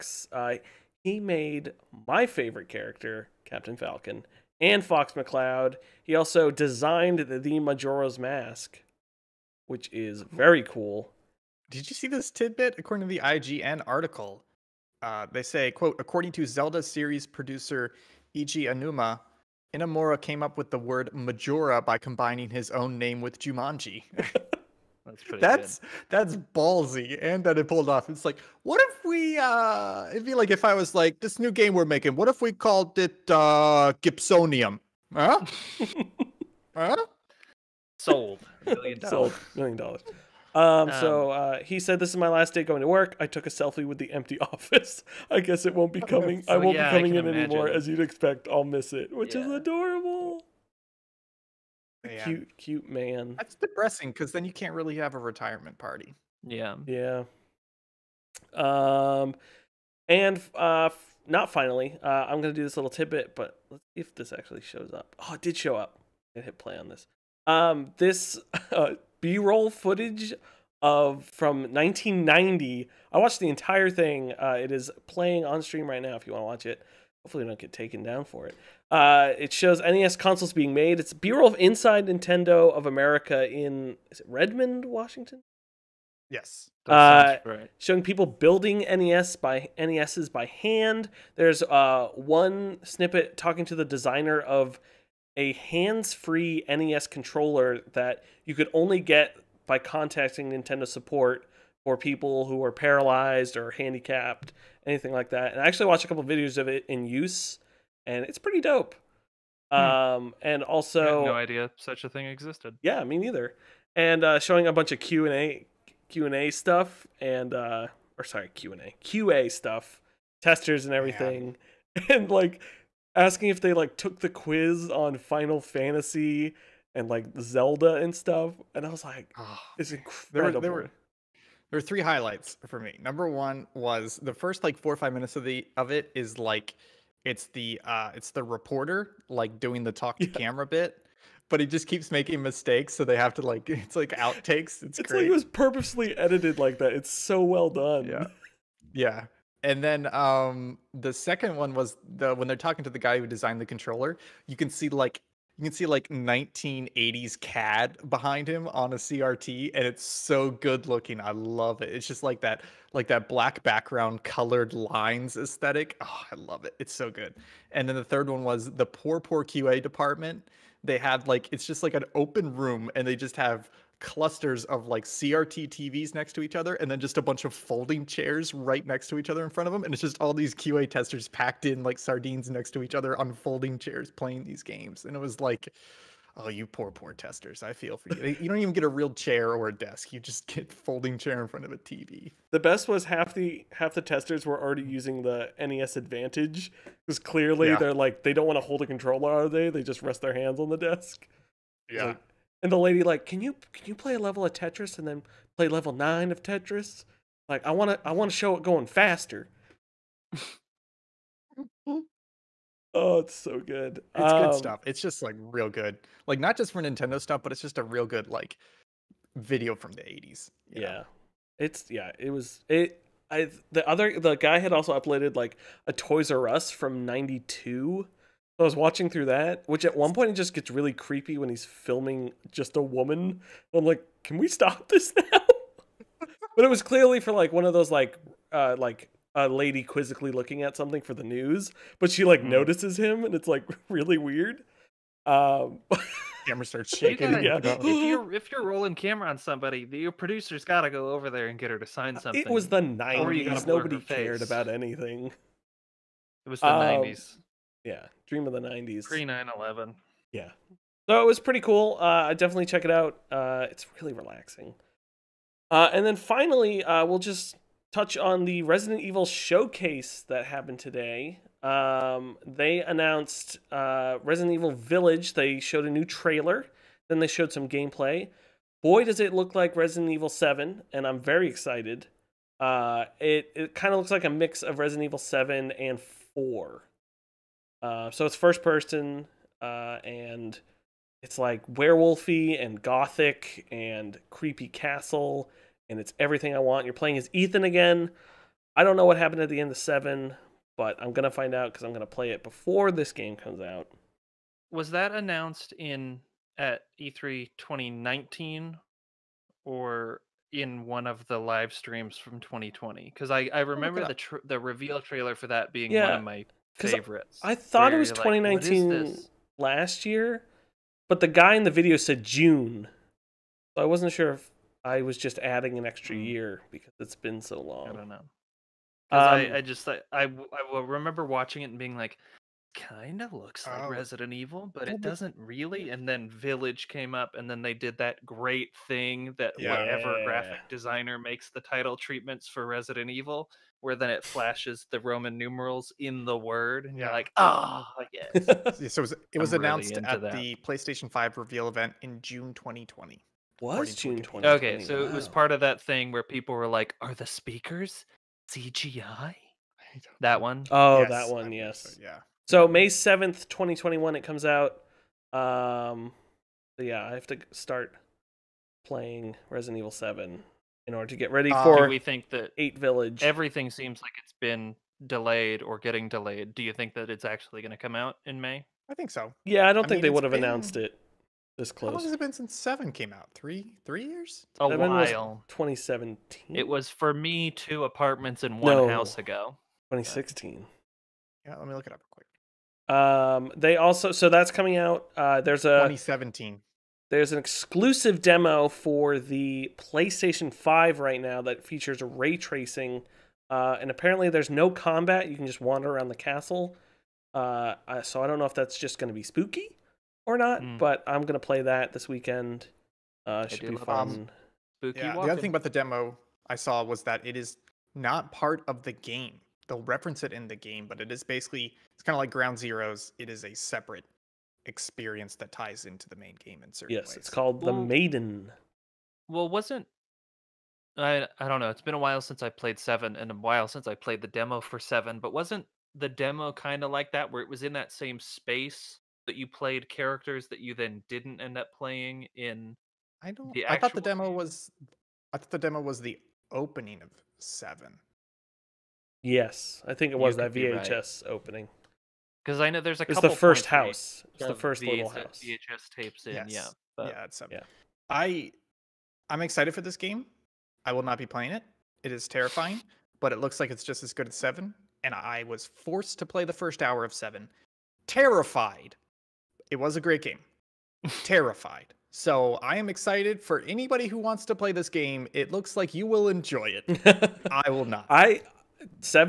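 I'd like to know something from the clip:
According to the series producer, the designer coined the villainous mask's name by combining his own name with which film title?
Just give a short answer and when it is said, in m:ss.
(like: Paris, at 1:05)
Jumanji, at 0:23.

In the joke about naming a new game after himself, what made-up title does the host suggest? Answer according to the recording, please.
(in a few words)
Gibsonium.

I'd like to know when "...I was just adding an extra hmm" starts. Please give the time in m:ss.
5:24.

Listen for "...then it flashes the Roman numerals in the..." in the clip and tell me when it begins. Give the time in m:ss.
5:43.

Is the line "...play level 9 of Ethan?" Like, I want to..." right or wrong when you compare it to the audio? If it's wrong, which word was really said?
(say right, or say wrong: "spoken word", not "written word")
wrong: "Tetris", not "Ethan".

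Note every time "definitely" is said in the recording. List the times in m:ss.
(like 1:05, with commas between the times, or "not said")
4:22.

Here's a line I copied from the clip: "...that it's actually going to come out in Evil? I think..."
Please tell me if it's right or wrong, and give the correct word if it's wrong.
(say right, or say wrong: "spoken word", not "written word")
wrong: "May", not "Evil".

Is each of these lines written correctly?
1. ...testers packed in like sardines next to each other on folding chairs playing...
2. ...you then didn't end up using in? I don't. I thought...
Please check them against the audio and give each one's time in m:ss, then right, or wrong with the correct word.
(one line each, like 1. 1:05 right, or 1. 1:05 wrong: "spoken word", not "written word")
1. 3:00 right
2. 7:20 wrong: "playing", not "using".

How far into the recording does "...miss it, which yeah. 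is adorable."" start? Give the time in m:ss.
0:48.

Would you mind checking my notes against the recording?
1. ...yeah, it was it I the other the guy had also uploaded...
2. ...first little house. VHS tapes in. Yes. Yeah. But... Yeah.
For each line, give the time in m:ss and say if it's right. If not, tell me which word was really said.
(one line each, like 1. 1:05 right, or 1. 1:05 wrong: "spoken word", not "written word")
1. 3:41 right
2. 7:34 right.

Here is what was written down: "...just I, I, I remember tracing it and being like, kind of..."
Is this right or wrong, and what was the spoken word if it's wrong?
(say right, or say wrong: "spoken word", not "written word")
wrong: "watching", not "tracing".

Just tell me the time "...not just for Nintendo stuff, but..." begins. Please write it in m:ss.
3:36.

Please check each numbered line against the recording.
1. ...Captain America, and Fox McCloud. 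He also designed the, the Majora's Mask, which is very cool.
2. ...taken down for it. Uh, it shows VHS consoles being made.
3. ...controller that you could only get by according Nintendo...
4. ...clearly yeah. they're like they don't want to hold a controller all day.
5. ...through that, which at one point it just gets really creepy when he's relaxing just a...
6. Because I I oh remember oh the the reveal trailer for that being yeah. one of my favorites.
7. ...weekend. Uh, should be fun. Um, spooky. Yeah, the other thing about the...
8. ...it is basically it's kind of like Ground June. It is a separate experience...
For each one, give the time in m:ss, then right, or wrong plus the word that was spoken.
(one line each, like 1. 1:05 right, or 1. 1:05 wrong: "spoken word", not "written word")
1. 0:03 wrong: "Falcon", not "America"
2. 1:17 wrong: "NES", not "VHS"
3. 1:37 wrong: "contacting", not "according"
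4. 3:17 right
5. 3:49 wrong: "filming", not "relaxing"
6. 5:13 right
7. 6:52 right
8. 7:01 wrong: "Zeroes", not "June".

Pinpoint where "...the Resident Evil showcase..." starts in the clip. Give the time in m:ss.
4:28.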